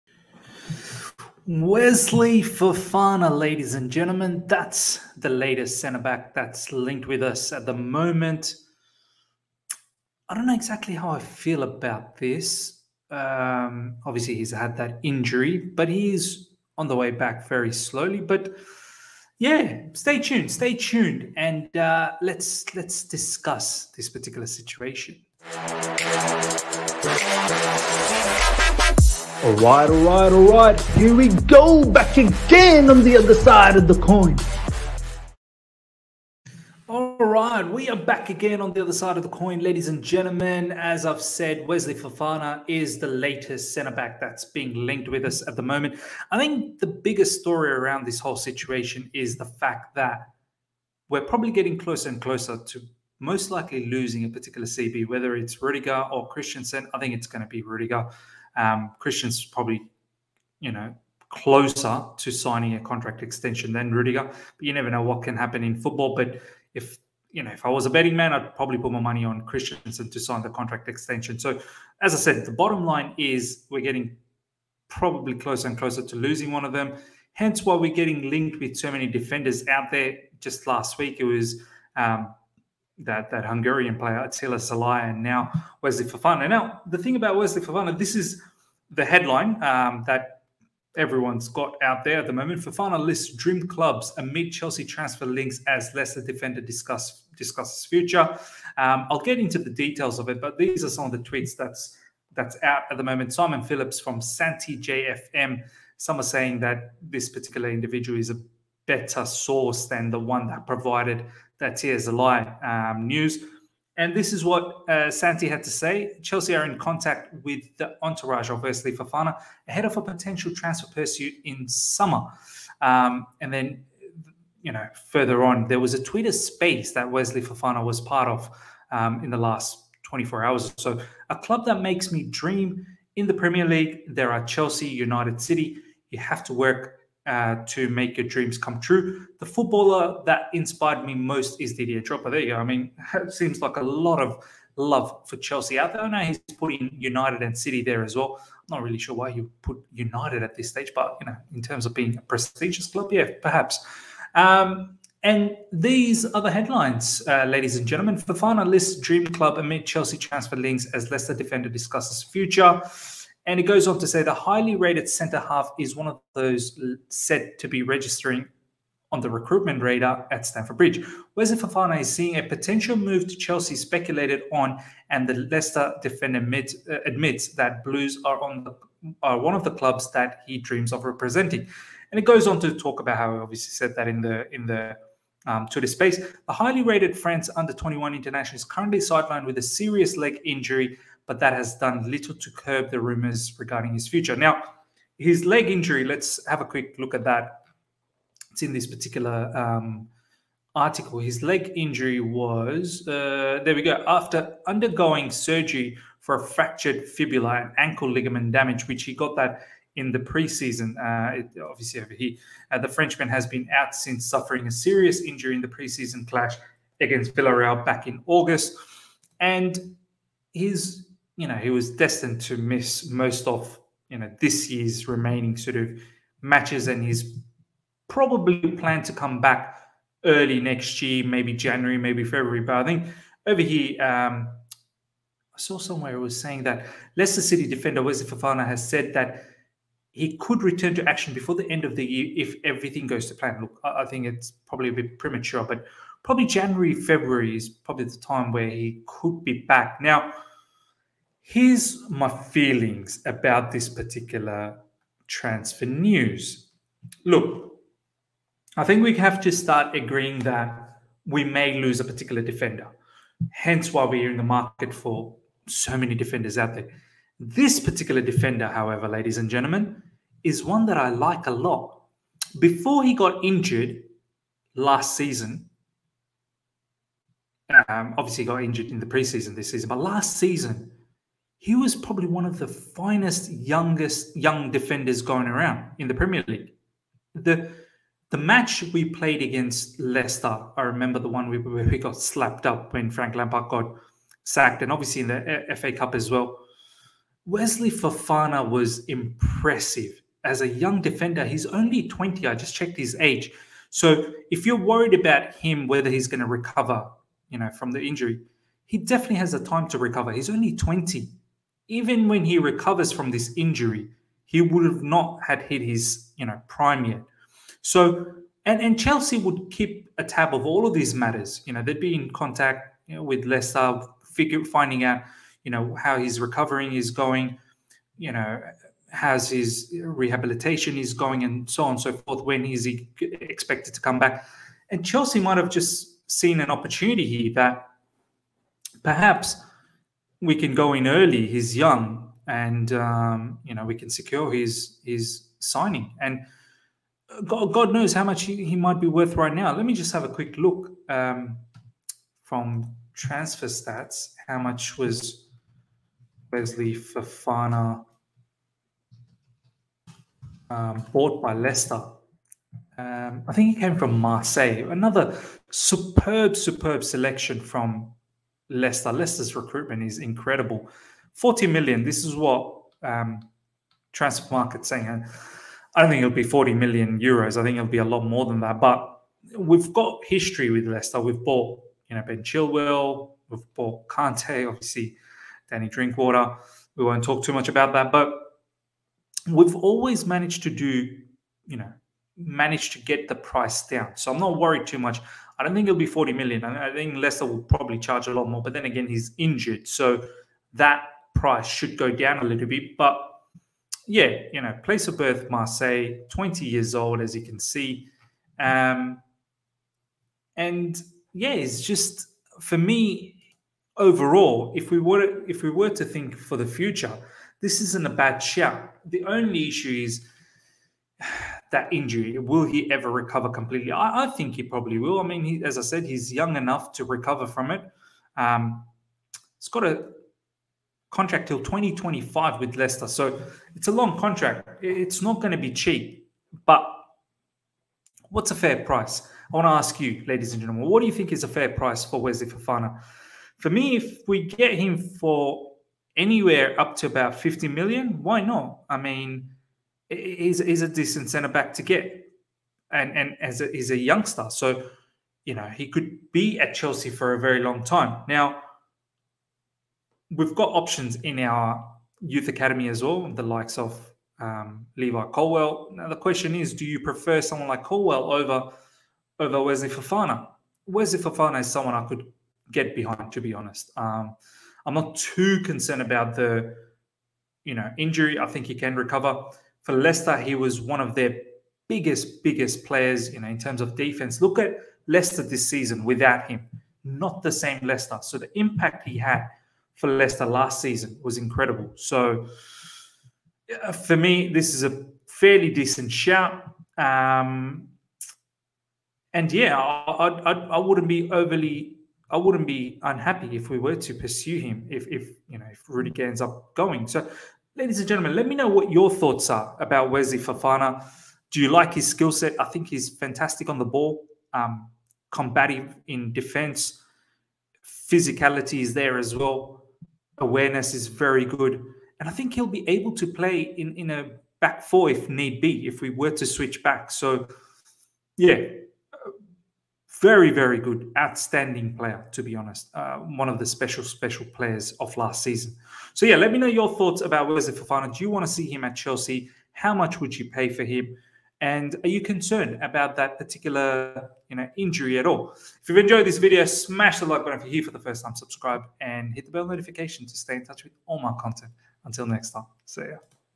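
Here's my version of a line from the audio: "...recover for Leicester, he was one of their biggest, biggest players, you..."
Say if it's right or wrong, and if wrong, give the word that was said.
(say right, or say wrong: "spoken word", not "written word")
right.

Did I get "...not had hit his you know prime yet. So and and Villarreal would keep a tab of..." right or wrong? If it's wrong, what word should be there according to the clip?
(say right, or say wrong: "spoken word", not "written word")
wrong: "Chelsea", not "Villarreal".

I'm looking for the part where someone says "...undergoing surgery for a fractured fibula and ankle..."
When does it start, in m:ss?
3:24.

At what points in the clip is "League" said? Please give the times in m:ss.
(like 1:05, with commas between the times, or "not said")
2:13, 4:46.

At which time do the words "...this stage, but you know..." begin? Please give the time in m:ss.
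2:30.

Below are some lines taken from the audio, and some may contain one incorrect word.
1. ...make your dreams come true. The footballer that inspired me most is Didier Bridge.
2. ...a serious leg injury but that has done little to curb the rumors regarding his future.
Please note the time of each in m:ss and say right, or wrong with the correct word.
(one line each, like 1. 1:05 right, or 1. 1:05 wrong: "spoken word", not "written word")
1. 2:17 wrong: "Drogba", not "Bridge"
2. 3:09 right.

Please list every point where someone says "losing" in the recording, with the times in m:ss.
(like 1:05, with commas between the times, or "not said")
0:53, 1:16.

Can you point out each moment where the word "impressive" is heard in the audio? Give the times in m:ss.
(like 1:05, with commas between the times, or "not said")
4:59.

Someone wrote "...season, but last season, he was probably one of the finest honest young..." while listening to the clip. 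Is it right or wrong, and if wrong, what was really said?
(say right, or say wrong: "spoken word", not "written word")
wrong: "youngest", not "honest".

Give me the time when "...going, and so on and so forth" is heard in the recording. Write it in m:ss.
5:31.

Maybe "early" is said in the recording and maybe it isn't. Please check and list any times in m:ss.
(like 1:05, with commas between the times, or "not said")
3:50, 5:41.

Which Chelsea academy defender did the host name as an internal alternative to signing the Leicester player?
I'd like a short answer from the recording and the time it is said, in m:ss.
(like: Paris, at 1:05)
Levi Colwill, at 7:44.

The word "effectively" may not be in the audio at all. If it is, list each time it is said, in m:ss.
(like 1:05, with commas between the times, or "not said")
not said.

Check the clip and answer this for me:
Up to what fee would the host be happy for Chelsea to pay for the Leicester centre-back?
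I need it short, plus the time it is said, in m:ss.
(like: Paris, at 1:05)
50 million, at 7:27.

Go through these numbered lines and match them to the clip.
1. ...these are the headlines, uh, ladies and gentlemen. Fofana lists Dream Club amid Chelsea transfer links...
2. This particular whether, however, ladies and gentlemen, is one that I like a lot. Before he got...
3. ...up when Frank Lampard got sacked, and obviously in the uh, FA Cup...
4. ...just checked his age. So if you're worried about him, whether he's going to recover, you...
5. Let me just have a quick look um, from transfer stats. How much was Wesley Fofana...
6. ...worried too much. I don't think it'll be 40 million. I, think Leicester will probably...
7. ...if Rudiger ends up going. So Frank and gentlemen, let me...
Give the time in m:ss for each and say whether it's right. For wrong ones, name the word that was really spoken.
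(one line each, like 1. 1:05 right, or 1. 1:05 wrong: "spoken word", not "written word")
1. 2:35 right
2. 4:27 wrong: "defender", not "whether"
3. 4:52 right
4. 5:02 right
5. 5:49 right
6. 6:34 right
7. 8:25 wrong: "Ladies", not "Frank".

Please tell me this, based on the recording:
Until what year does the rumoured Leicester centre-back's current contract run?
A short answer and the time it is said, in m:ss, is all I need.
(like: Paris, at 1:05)
2025, at 7:11.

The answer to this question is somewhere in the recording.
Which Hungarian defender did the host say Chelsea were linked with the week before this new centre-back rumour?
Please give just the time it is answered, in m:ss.
1:24.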